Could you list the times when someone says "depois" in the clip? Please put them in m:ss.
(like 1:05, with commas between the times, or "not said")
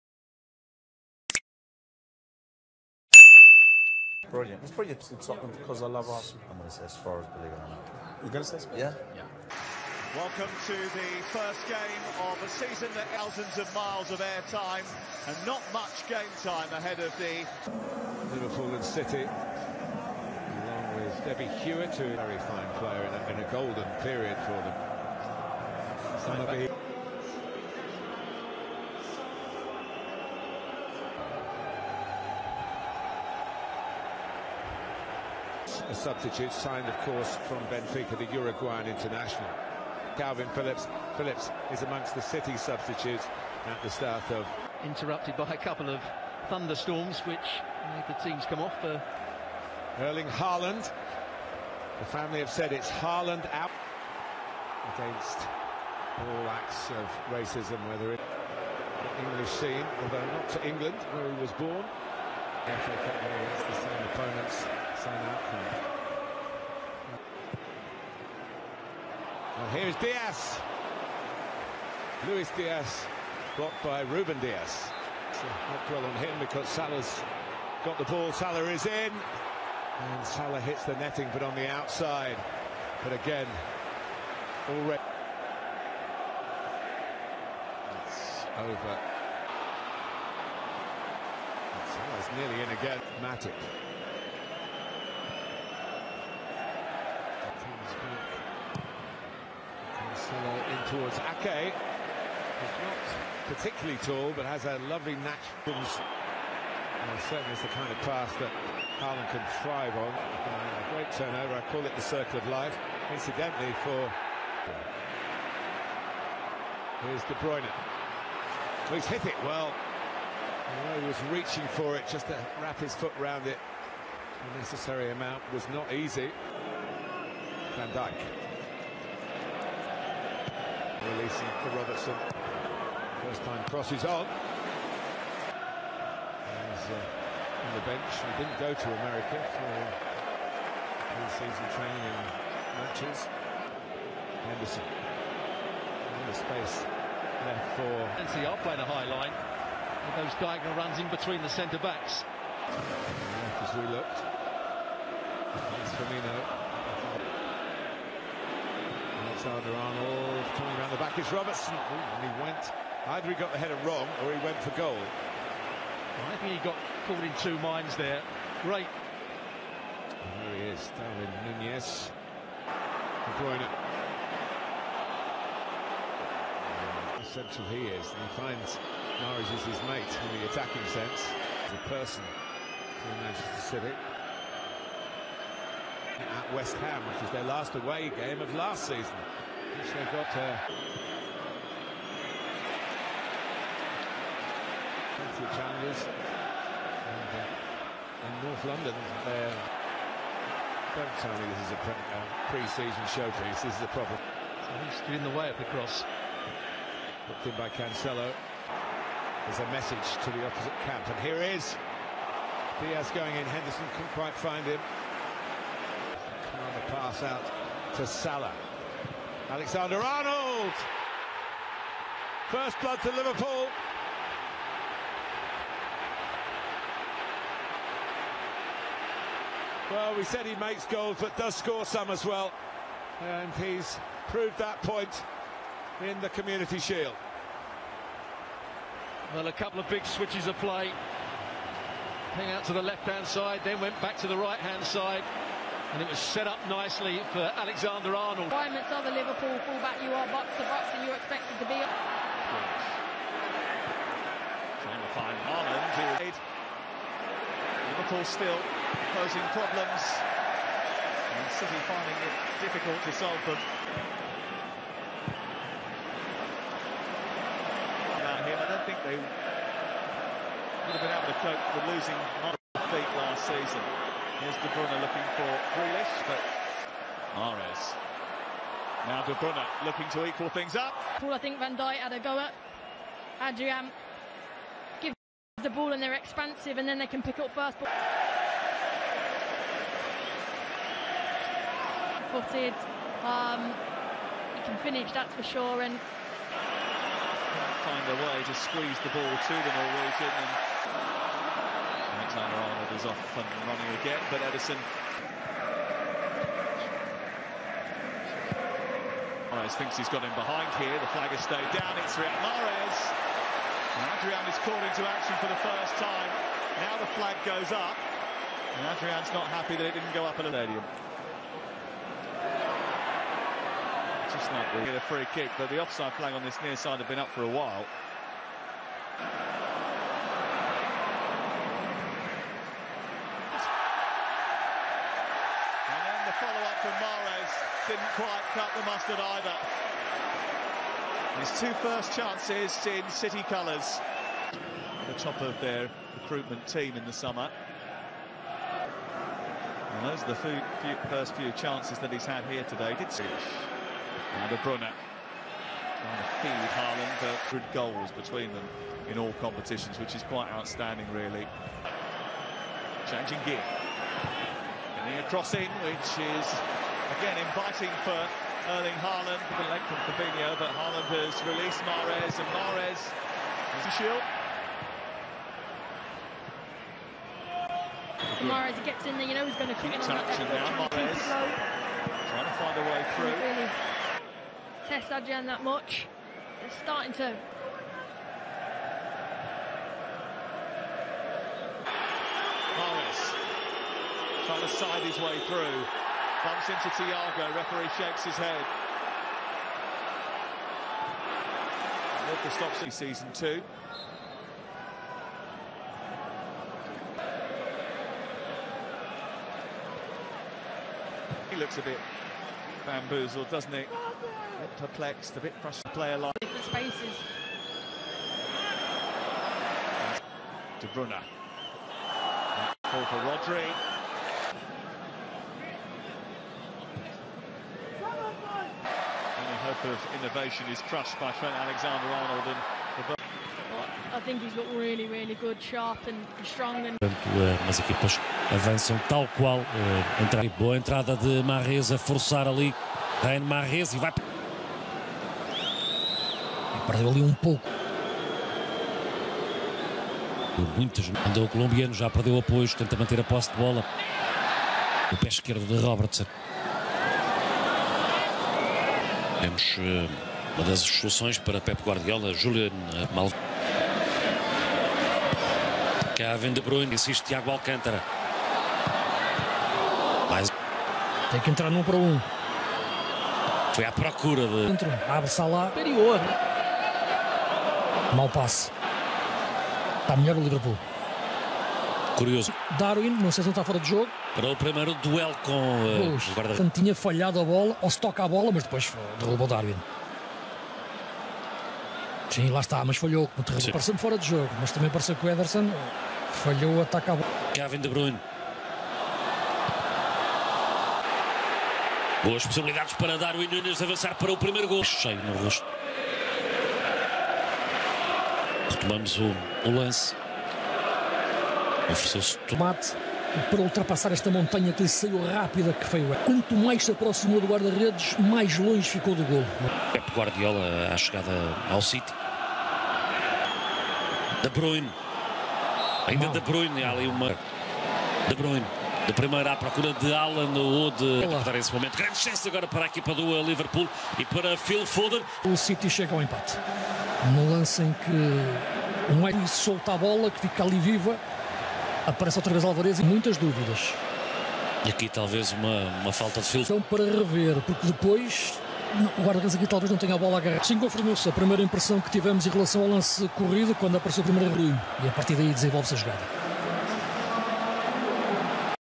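8:08, 9:07.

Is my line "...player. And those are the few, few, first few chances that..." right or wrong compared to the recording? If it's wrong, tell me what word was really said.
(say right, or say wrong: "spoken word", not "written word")
wrong: "summer", not "player".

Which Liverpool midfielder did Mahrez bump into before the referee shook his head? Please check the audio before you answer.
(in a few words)
Thiago.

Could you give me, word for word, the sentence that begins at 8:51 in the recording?
Grande chance agora para a equipa do eh, Liverpool e para Phil Foden.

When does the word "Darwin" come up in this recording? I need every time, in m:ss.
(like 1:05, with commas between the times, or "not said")
2:50, 8:02, 8:09, 8:23.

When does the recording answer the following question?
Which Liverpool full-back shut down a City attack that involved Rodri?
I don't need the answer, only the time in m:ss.
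7:11.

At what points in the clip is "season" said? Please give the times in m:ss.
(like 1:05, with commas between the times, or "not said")
0:12, 2:21, 3:08, 3:22, 4:33, 6:42.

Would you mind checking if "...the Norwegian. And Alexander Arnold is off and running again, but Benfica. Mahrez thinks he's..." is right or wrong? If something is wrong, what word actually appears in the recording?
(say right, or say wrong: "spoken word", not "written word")
wrong: "Ederson", not "Benfica".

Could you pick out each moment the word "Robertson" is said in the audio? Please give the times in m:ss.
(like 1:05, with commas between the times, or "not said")
2:11, 2:41, 7:35.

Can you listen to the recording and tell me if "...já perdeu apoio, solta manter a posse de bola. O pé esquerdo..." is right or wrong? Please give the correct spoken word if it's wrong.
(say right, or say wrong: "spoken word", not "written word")
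wrong: "tenta", not "solta".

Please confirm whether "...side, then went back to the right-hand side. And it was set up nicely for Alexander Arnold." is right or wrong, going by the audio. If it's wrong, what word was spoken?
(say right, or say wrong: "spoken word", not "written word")
right.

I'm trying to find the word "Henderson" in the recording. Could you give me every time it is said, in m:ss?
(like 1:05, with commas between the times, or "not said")
2:24, 3:33.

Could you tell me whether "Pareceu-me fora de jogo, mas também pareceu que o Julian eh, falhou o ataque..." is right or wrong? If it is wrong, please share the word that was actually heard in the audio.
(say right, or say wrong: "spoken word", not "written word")
wrong: "Ederson", not "Julian".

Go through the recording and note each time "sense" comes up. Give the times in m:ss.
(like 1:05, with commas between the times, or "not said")
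3:00.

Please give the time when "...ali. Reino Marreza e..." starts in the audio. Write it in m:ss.
7:22.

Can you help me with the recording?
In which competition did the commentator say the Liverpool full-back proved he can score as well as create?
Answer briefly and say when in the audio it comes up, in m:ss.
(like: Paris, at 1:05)
Community Shield, at 3:56.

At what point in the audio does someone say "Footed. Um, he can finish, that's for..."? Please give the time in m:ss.
4:52.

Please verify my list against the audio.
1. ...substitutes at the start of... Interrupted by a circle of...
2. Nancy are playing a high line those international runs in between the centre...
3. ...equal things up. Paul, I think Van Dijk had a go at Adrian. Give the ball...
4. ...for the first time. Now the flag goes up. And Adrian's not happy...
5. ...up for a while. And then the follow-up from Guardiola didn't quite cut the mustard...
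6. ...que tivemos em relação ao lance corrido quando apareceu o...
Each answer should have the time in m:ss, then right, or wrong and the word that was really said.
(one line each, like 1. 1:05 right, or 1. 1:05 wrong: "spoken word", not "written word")
1. 0:42 wrong: "couple", not "circle"
2. 2:28 wrong: "diagonal", not "international"
3. 4:40 right
4. 5:15 right
5. 5:27 wrong: "Mahrez", not "Guardiola"
6. 9:12 right.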